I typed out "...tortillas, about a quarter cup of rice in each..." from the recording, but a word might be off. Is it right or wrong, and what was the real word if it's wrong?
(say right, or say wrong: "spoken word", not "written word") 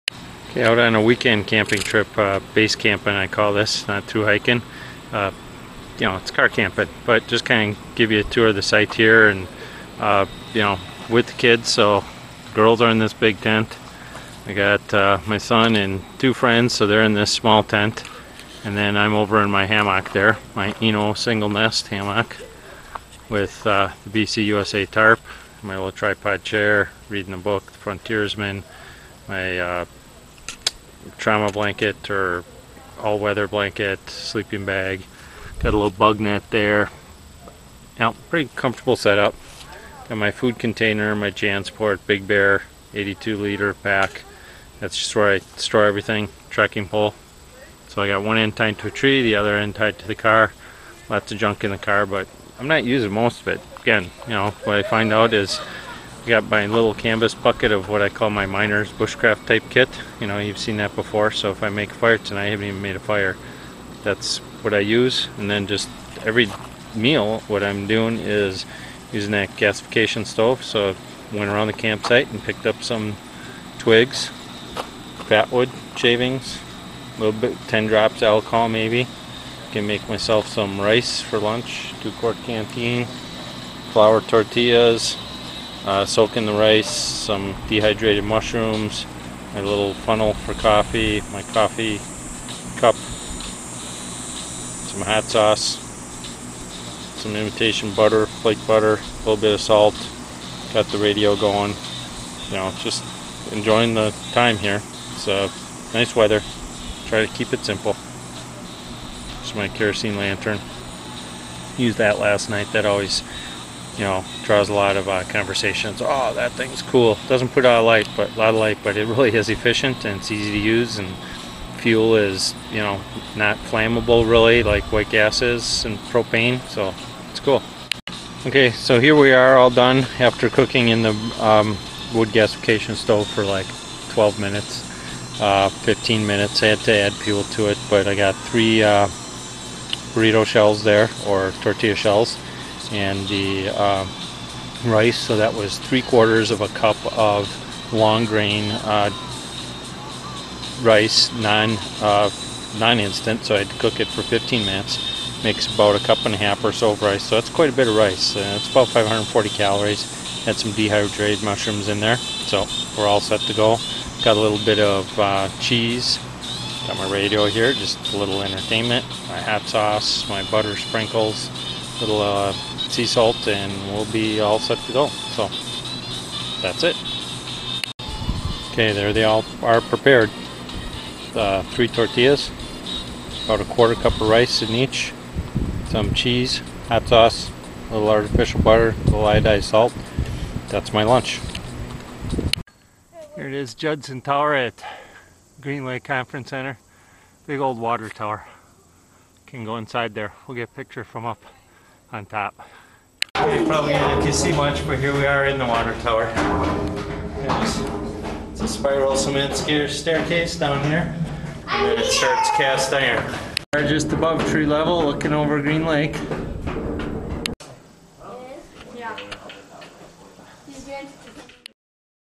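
right.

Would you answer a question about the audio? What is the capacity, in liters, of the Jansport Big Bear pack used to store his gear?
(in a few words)
82.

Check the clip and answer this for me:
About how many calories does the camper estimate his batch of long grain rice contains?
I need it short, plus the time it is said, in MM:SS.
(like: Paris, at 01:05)
540, at 02:38.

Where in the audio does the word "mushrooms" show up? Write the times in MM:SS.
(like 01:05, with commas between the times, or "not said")
01:28, 02:41.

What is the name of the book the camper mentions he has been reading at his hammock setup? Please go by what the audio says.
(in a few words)
The Frontiersman.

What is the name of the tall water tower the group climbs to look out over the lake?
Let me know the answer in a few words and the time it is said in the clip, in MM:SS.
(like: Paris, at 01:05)
Judson Tower, at 03:13.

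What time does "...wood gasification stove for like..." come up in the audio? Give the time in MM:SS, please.
02:12.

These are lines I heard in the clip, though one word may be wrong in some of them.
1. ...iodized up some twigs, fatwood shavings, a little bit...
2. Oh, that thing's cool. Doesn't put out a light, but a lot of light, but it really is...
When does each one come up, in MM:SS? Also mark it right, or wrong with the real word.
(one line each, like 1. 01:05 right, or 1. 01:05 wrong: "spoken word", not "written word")
1. 01:12 wrong: "picked", not "iodized"
2. 01:56 right.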